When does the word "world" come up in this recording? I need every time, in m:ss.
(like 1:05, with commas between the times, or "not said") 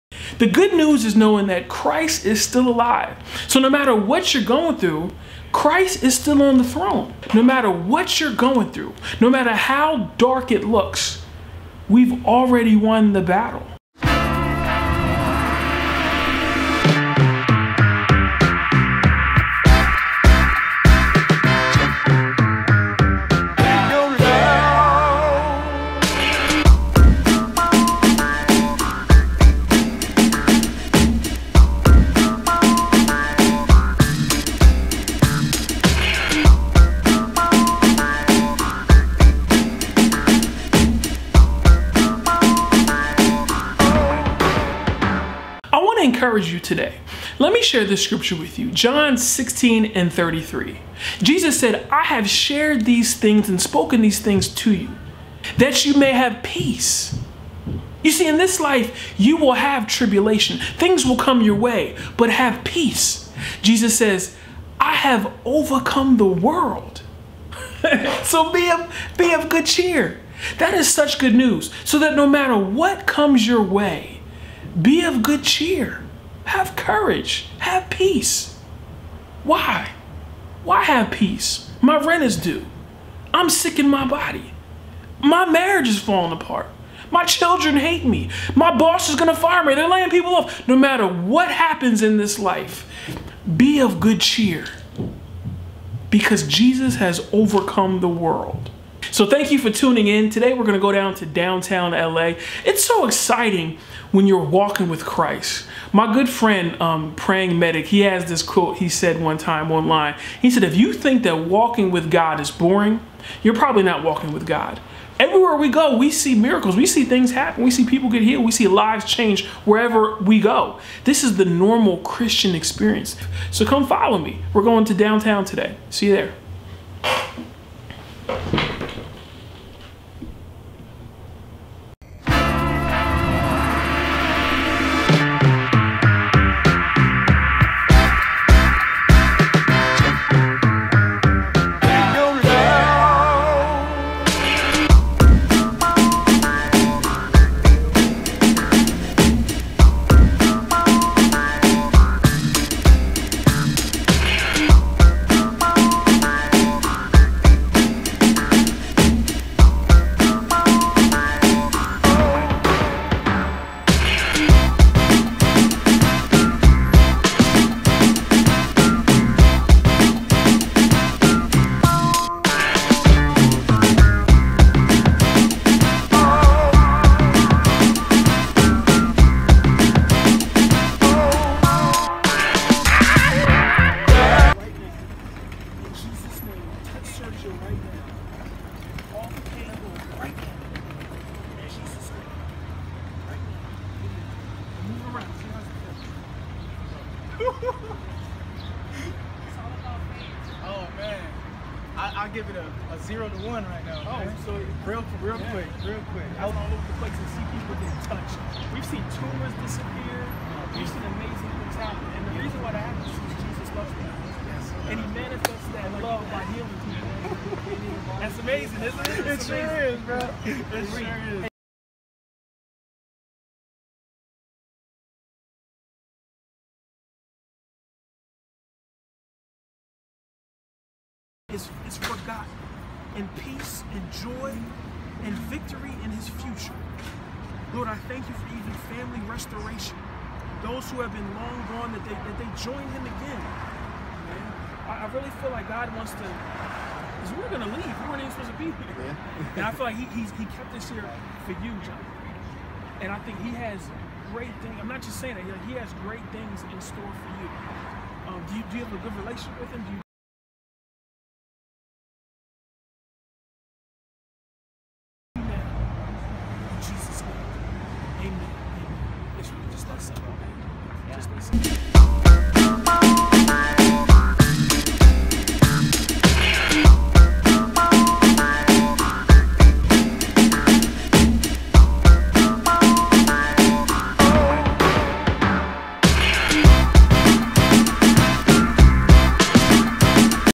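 1:06, 1:38.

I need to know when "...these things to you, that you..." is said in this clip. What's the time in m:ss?
0:54.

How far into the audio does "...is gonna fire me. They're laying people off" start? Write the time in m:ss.
1:29.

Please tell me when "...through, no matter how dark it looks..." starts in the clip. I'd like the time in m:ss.
0:08.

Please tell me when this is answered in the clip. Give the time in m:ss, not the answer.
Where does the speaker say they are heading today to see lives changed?
1:41.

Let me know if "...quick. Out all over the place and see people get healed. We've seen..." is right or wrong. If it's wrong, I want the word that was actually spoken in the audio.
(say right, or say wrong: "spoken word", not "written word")
wrong: "touched", not "healed".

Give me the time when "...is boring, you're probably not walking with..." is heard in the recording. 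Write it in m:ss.
1:52.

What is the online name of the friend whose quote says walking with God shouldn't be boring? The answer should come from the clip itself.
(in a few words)
Praying Medic.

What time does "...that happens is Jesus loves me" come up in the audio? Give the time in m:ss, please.
3:32.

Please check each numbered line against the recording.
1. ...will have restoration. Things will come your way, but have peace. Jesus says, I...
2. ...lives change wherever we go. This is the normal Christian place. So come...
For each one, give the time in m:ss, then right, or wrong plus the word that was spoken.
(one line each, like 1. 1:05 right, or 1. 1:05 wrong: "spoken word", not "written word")
1. 0:59 wrong: "tribulation", not "restoration"
2. 1:58 wrong: "experience", not "place".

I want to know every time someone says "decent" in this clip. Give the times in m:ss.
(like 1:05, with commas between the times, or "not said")
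not said.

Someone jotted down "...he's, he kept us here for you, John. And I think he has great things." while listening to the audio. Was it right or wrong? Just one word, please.
right.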